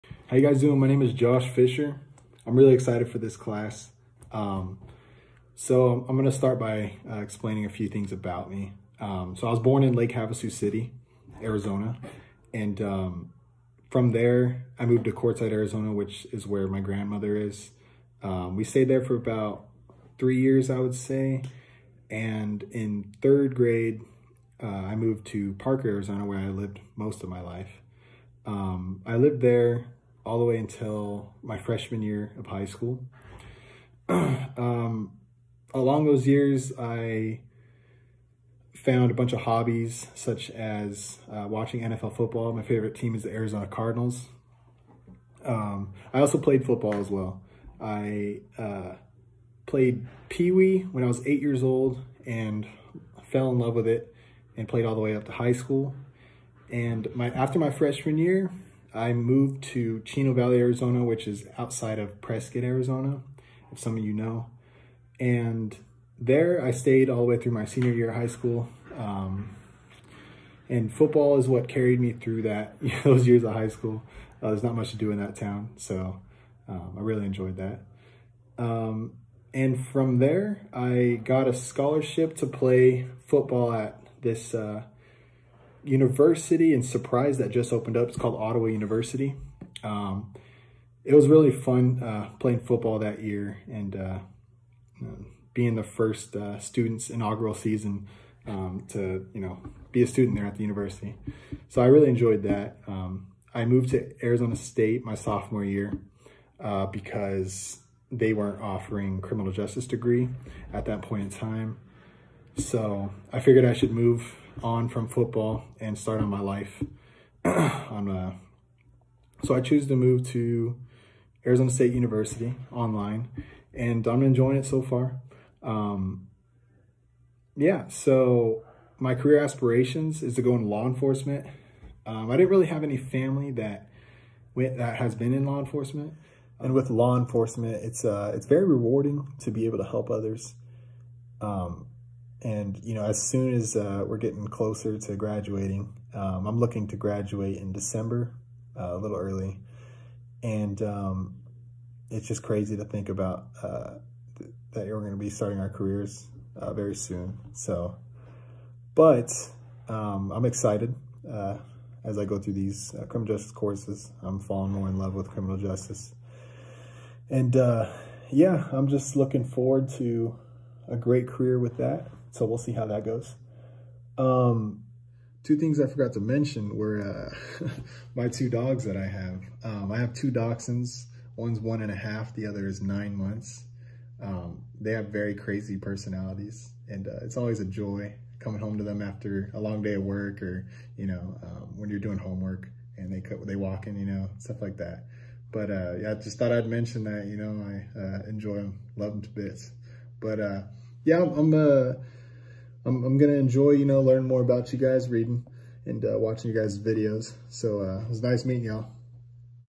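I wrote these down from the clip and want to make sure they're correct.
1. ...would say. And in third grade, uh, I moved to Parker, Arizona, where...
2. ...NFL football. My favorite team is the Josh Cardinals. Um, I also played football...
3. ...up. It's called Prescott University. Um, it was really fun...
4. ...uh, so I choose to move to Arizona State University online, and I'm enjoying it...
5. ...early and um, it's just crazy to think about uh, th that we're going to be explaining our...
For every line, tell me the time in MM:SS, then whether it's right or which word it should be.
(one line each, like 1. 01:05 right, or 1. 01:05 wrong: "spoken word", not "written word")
1. 00:20 right
2. 00:41 wrong: "Arizona", not "Josh"
3. 01:27 wrong: "Ottawa", not "Prescott"
4. 01:58 right
5. 02:29 wrong: "starting", not "explaining".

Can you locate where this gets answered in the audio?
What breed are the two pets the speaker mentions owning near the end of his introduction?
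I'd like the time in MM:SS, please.
03:00.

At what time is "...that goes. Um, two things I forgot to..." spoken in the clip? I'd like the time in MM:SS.
02:52.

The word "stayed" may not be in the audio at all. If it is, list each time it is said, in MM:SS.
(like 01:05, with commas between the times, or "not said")
00:18, 01:06.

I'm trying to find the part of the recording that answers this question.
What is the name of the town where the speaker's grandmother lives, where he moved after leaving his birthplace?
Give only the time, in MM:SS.
00:15.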